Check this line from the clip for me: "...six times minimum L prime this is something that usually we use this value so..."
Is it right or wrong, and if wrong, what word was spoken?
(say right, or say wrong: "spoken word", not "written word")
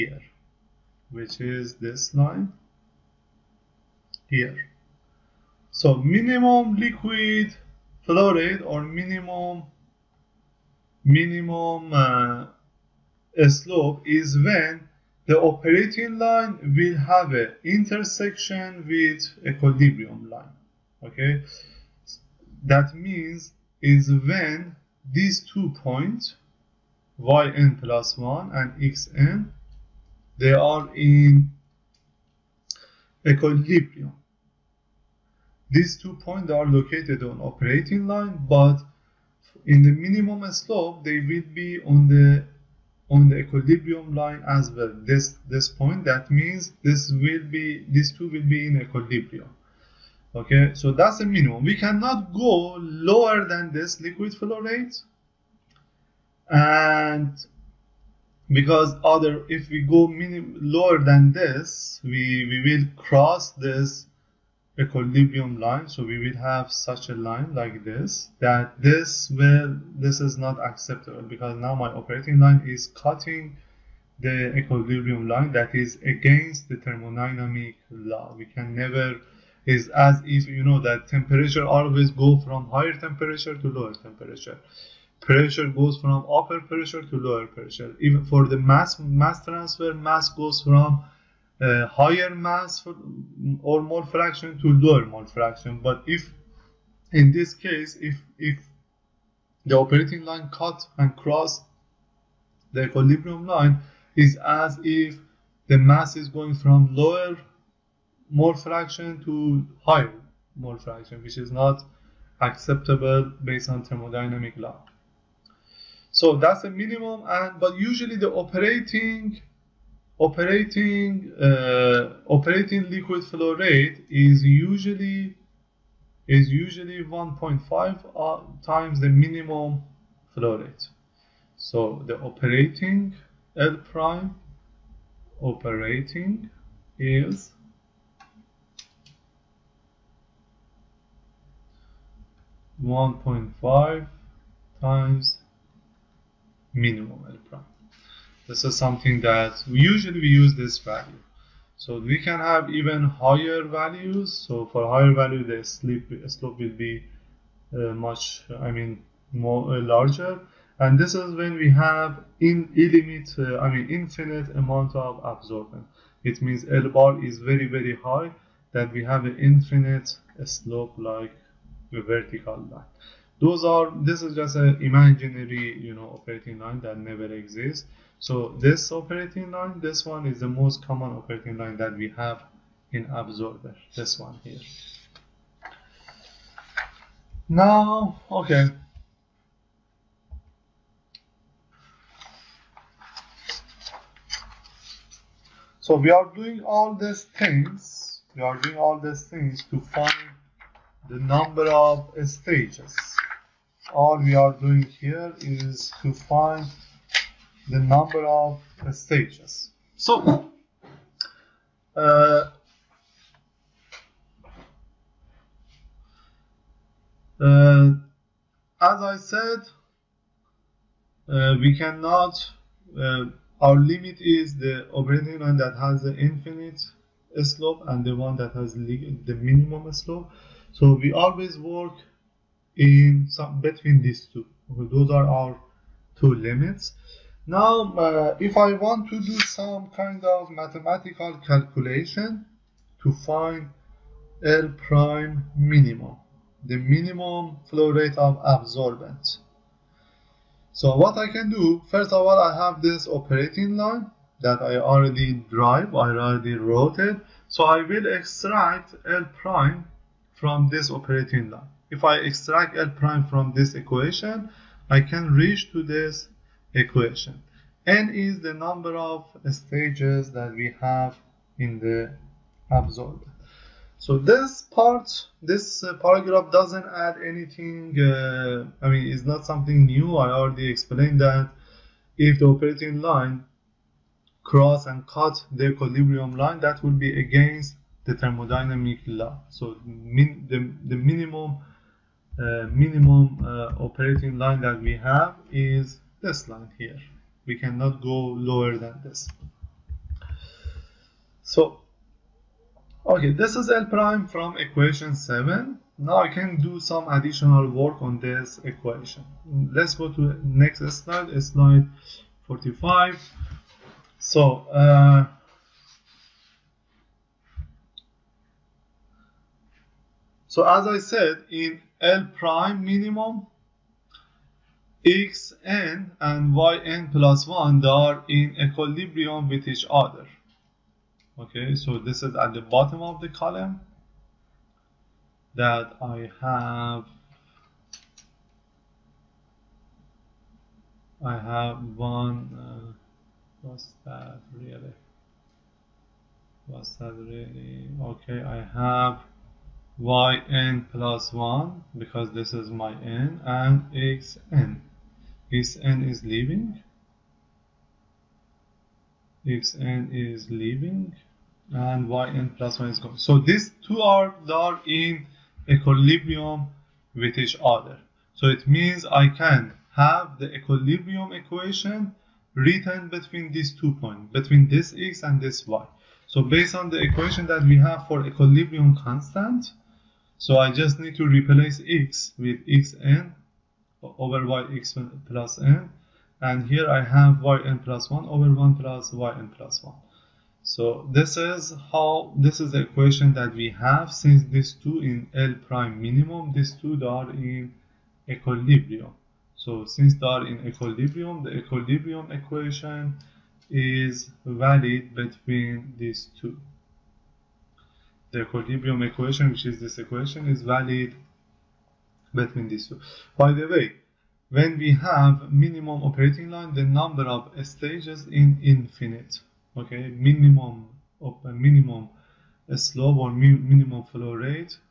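wrong: "five", not "six".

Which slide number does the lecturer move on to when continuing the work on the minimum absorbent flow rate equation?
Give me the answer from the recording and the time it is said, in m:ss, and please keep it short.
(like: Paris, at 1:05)
45, at 5:11.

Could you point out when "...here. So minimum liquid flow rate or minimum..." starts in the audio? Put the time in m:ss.
0:04.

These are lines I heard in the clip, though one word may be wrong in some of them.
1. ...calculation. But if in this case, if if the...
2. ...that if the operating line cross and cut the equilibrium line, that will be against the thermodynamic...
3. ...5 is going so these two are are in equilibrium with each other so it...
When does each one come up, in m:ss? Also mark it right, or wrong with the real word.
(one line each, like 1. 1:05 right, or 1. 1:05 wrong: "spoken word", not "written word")
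1. 1:35 wrong: "fraction", not "calculation"
2. 4:41 right
3. 6:02 wrong: "1", not "5".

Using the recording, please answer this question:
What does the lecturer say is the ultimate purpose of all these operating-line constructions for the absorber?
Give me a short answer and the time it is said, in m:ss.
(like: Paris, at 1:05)
find the number of stages, at 3:26.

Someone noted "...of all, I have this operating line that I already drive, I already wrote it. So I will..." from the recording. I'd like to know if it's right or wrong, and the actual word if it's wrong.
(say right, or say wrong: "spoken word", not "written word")
right.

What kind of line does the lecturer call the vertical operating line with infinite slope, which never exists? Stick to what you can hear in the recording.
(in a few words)
imaginary.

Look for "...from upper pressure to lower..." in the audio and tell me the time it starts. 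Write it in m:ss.
1:25.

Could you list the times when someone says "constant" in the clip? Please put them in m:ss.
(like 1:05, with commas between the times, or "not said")
6:18.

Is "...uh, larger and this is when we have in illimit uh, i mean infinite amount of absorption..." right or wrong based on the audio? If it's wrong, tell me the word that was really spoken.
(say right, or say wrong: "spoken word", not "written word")
right.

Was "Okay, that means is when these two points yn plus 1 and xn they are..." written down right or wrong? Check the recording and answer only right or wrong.
right.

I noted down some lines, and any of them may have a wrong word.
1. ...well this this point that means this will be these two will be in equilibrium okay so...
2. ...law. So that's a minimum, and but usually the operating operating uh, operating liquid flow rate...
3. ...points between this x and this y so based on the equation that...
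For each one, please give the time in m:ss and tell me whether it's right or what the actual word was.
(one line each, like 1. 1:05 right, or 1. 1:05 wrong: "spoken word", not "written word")
1. 0:44 right
2. 1:54 right
3. 6:13 right.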